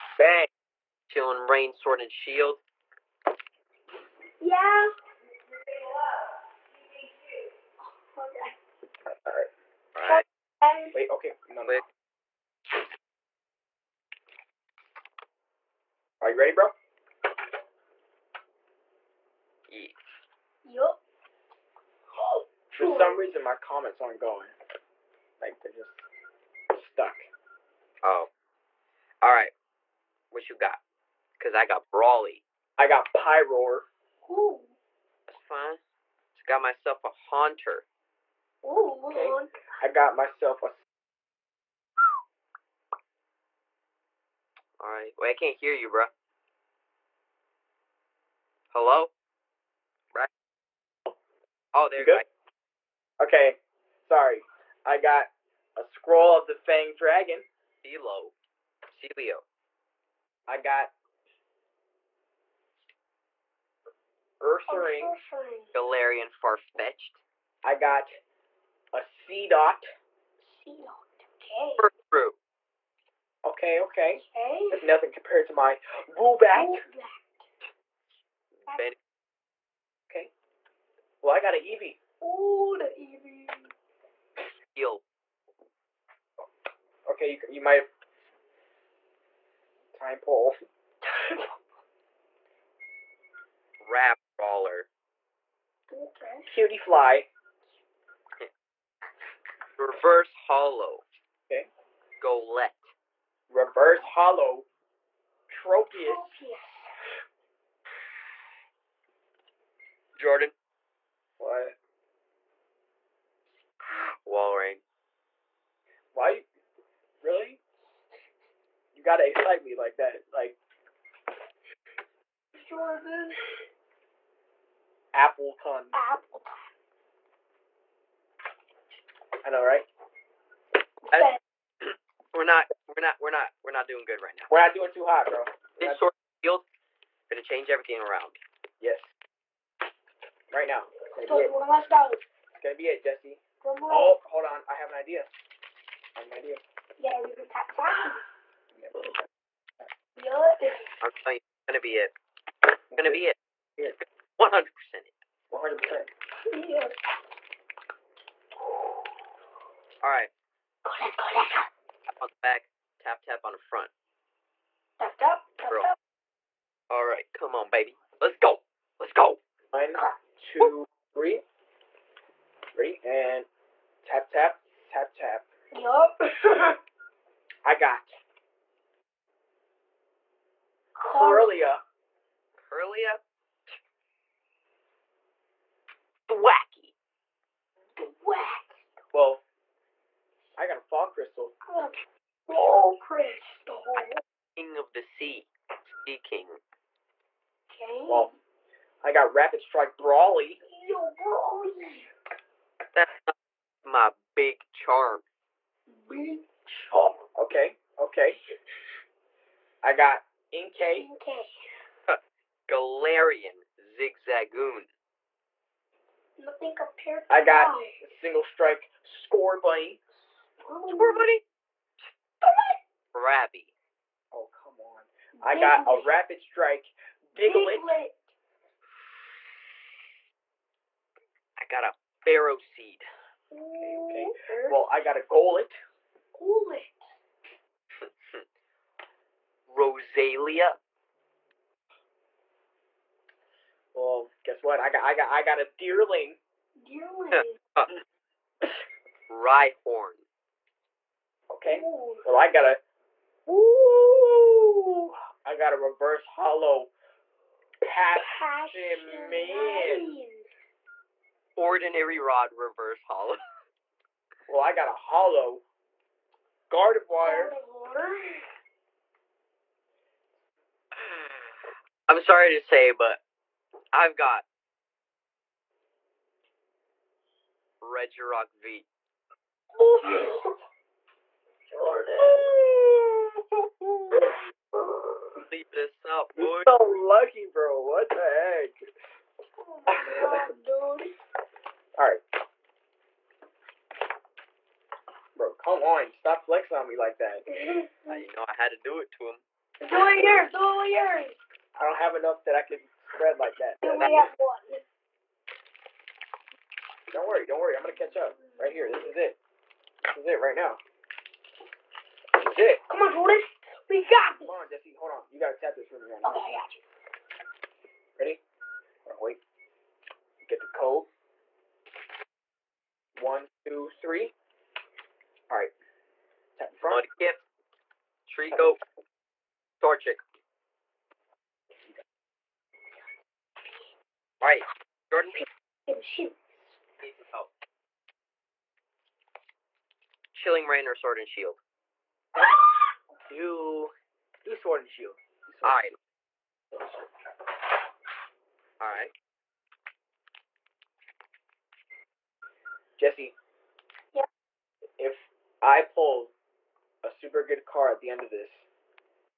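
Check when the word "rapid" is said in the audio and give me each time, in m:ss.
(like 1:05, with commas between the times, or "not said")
3:19, 3:46.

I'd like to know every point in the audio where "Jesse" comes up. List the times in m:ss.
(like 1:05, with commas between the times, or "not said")
2:23, 5:14, 5:52.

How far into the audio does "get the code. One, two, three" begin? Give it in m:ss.
5:20.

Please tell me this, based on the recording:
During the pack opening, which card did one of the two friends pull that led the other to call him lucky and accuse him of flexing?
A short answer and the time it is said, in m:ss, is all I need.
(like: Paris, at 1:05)
Regirock V, at 4:37.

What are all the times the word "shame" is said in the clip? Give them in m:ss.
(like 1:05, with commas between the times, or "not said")
not said.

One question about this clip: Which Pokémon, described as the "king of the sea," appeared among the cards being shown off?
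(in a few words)
Seaking.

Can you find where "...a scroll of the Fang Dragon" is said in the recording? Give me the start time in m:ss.
0:55.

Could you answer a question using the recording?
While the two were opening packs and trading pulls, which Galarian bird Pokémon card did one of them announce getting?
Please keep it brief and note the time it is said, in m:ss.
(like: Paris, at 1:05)
Galarian Farfetch'd, at 1:05.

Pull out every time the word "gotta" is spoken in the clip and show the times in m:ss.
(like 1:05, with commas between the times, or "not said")
1:59, 5:15.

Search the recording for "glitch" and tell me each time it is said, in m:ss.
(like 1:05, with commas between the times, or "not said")
not said.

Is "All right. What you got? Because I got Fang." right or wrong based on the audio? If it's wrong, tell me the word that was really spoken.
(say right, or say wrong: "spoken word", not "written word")
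wrong: "Brawly", not "Fang".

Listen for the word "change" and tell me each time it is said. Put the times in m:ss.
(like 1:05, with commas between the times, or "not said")
2:17.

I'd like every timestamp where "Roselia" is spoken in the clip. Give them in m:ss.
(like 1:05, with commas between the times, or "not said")
3:59.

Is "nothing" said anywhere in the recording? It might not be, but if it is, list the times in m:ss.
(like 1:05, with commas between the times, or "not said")
1:14, 3:36.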